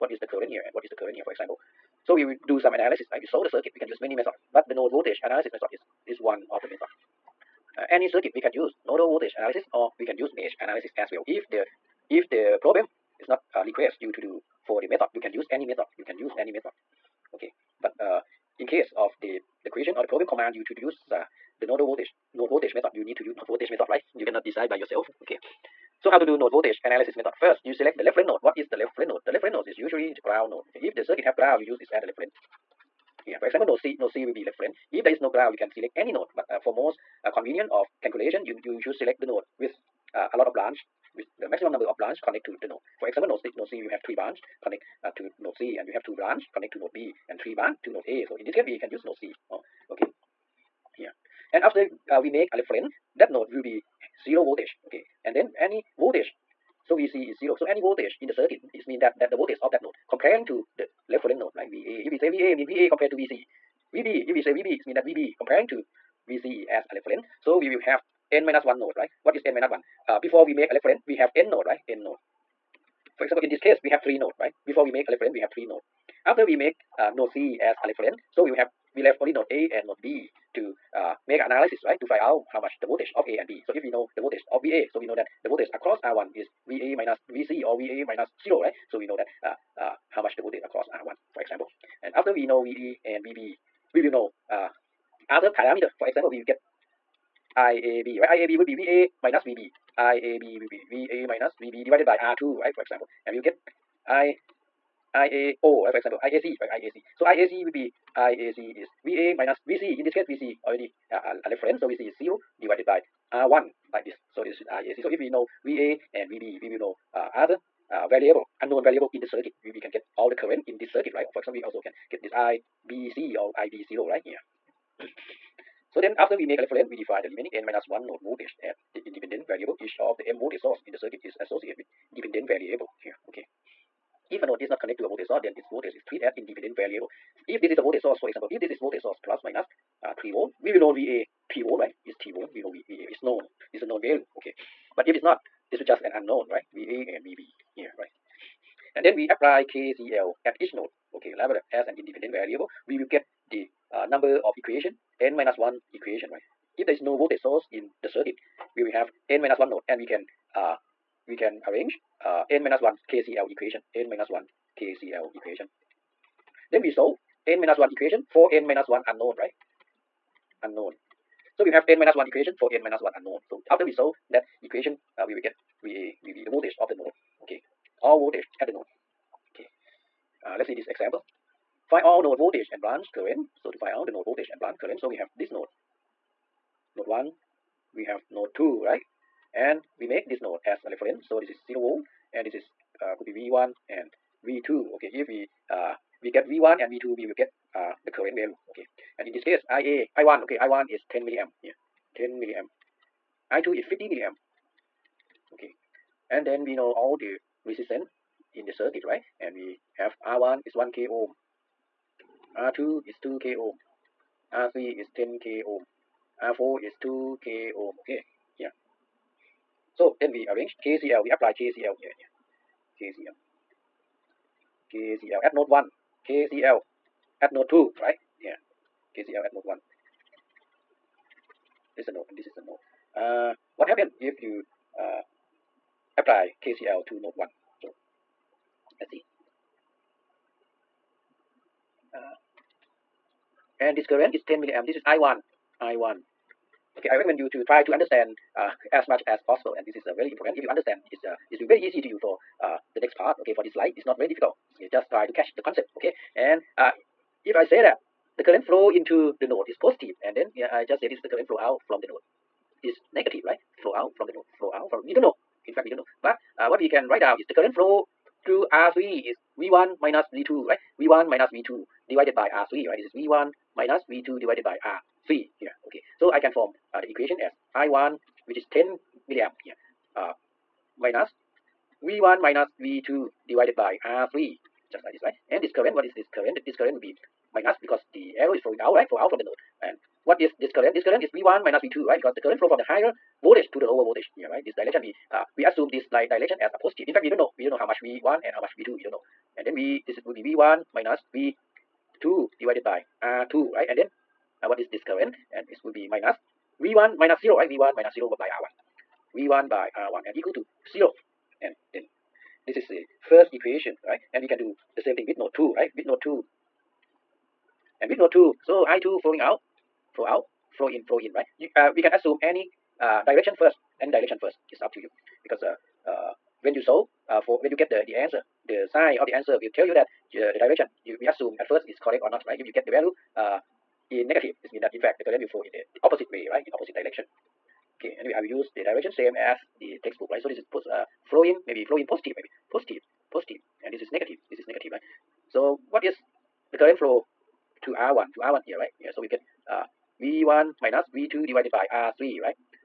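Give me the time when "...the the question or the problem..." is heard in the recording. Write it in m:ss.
0:19.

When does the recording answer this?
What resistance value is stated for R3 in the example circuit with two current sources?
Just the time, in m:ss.
3:34.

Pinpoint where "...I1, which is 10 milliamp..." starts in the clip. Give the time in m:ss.
4:37.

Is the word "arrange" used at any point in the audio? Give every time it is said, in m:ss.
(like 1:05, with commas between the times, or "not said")
2:41, 3:40.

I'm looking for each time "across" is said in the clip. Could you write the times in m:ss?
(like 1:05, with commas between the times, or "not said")
1:25, 1:30.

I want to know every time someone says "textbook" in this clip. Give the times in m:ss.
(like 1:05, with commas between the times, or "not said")
5:40.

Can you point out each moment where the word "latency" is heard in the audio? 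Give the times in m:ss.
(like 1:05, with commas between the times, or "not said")
not said.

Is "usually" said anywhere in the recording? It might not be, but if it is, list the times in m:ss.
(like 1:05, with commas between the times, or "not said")
0:29.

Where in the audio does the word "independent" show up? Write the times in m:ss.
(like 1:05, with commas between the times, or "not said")
2:09, 2:16, 2:31.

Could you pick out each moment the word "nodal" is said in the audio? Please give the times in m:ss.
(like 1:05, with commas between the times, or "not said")
0:08, 0:21.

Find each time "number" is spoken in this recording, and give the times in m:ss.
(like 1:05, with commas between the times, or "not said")
0:41, 2:34.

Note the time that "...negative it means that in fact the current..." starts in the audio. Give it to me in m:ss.
5:34.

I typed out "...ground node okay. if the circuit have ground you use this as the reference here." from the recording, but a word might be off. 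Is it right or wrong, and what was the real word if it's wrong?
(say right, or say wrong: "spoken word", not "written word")
right.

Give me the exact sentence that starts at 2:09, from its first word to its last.
Each of the m voltage source in the circuit is associated with dependent variable here.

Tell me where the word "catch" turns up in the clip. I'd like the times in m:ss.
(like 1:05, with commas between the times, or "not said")
4:15.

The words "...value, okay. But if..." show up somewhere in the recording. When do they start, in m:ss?
2:24.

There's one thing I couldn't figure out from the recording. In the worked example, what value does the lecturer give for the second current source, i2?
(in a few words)
50 milliamp.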